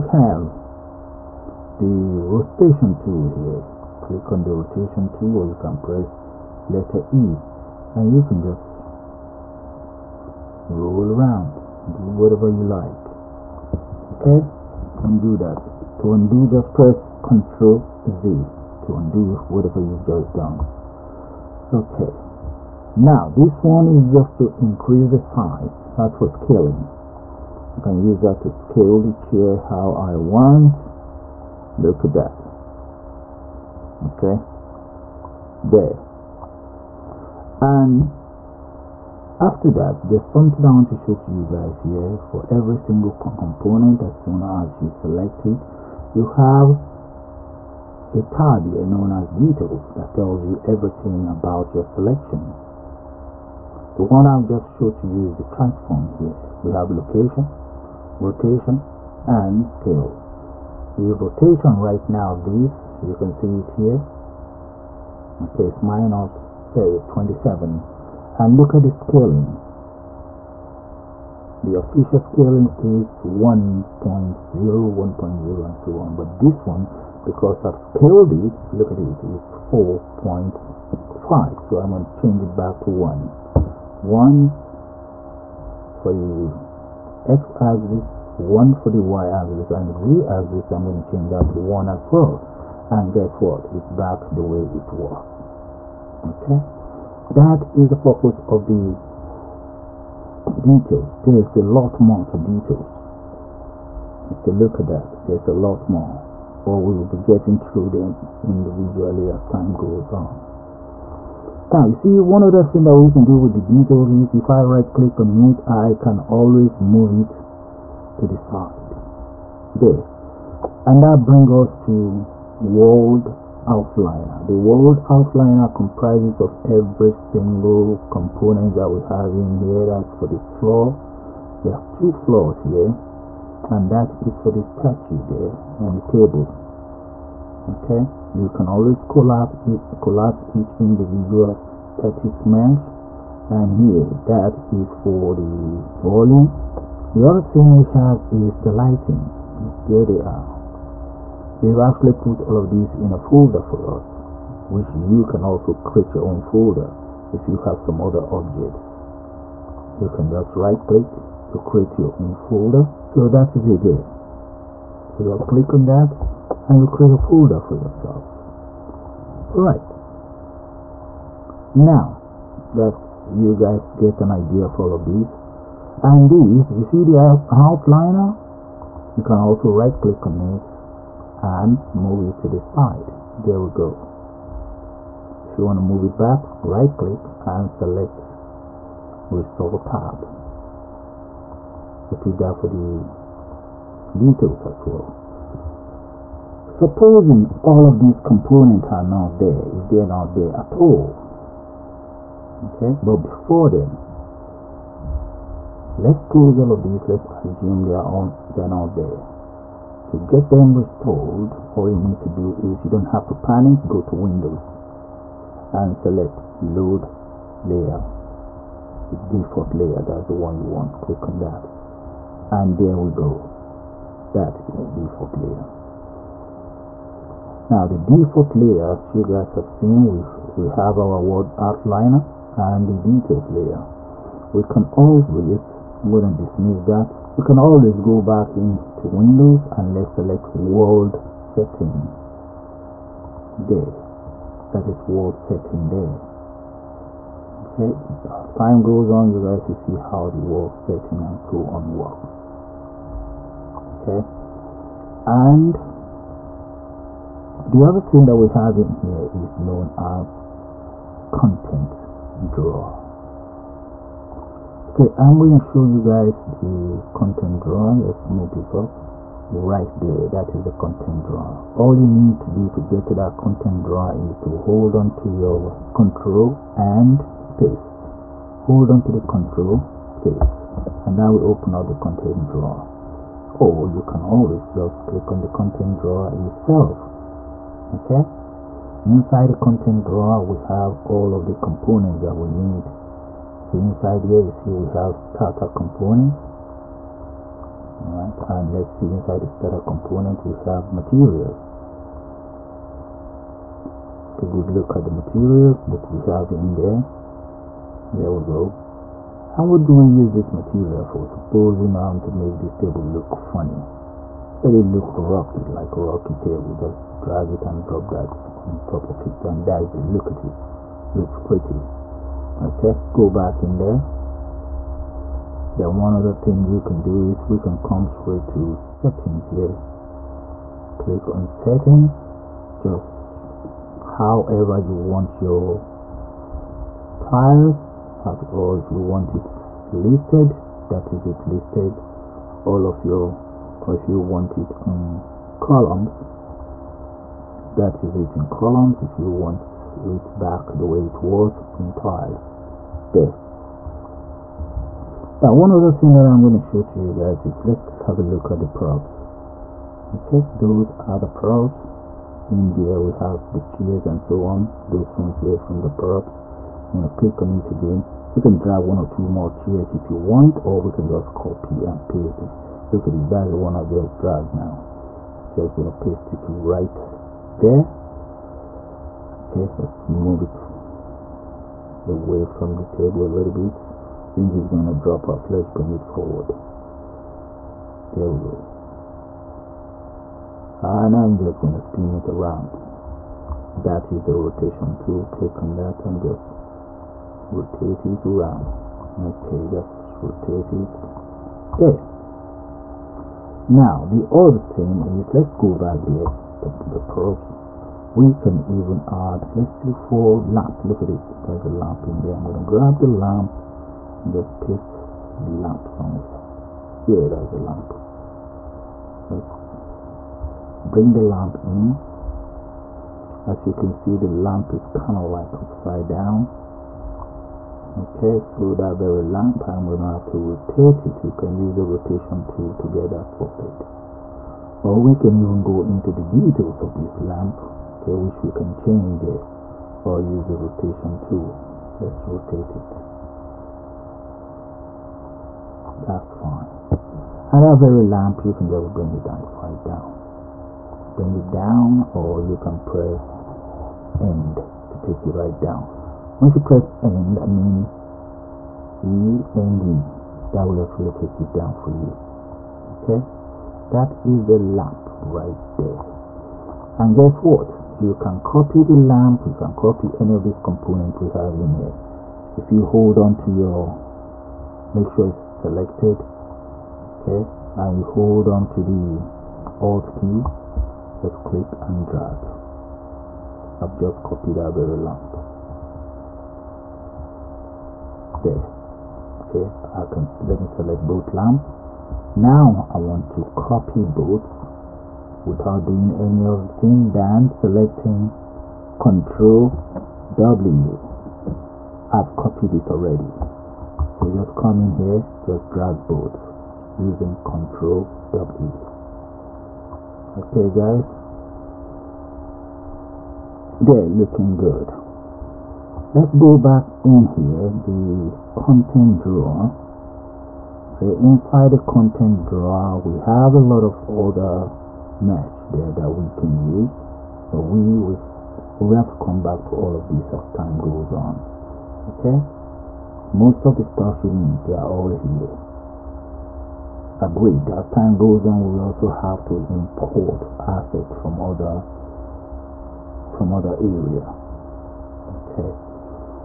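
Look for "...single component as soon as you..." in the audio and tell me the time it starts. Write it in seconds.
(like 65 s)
42 s.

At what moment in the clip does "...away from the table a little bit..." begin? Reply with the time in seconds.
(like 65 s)
382 s.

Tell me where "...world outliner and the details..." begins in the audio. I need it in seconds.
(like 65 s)
231 s.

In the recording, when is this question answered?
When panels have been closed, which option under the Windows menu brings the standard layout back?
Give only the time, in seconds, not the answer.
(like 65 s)
216 s.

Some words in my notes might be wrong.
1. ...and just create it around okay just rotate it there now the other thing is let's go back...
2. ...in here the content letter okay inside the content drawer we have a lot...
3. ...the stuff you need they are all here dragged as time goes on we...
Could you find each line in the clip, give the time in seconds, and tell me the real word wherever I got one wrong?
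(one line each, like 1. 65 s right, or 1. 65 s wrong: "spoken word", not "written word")
1. 396 s wrong: "rotate", not "create"
2. 517 s wrong: "drawer", not "letter"
3. 533 s wrong: "agreed", not "dragged".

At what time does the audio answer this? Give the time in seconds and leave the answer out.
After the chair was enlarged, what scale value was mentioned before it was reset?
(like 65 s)
79 s.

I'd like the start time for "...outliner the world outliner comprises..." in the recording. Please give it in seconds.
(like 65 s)
123 s.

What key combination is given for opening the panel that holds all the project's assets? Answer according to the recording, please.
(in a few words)
Control and space.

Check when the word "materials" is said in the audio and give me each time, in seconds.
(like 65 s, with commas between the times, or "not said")
300 s, 305 s, 310 s.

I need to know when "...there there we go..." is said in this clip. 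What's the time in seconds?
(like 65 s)
306 s.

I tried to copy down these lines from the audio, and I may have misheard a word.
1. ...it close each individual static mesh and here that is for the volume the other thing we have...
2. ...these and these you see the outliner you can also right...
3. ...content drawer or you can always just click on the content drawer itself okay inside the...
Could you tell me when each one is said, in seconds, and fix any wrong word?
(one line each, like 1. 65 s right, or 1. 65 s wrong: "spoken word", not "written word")
1. 139 s wrong: "collapse", not "close"
2. 175 s right
3. 281 s right.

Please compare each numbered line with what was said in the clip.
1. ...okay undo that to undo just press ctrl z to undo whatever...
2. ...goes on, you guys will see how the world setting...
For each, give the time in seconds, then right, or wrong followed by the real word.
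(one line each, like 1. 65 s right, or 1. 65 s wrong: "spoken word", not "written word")
1. 14 s right
2. 248 s right.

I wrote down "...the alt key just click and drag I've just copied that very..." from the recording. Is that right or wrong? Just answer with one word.
right.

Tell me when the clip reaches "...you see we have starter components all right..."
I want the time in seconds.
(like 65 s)
294 s.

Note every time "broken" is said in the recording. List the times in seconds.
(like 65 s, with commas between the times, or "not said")
not said.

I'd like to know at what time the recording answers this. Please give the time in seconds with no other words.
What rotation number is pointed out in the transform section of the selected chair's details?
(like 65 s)
65 s.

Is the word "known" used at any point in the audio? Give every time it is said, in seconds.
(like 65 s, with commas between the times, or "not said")
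48 s, 259 s.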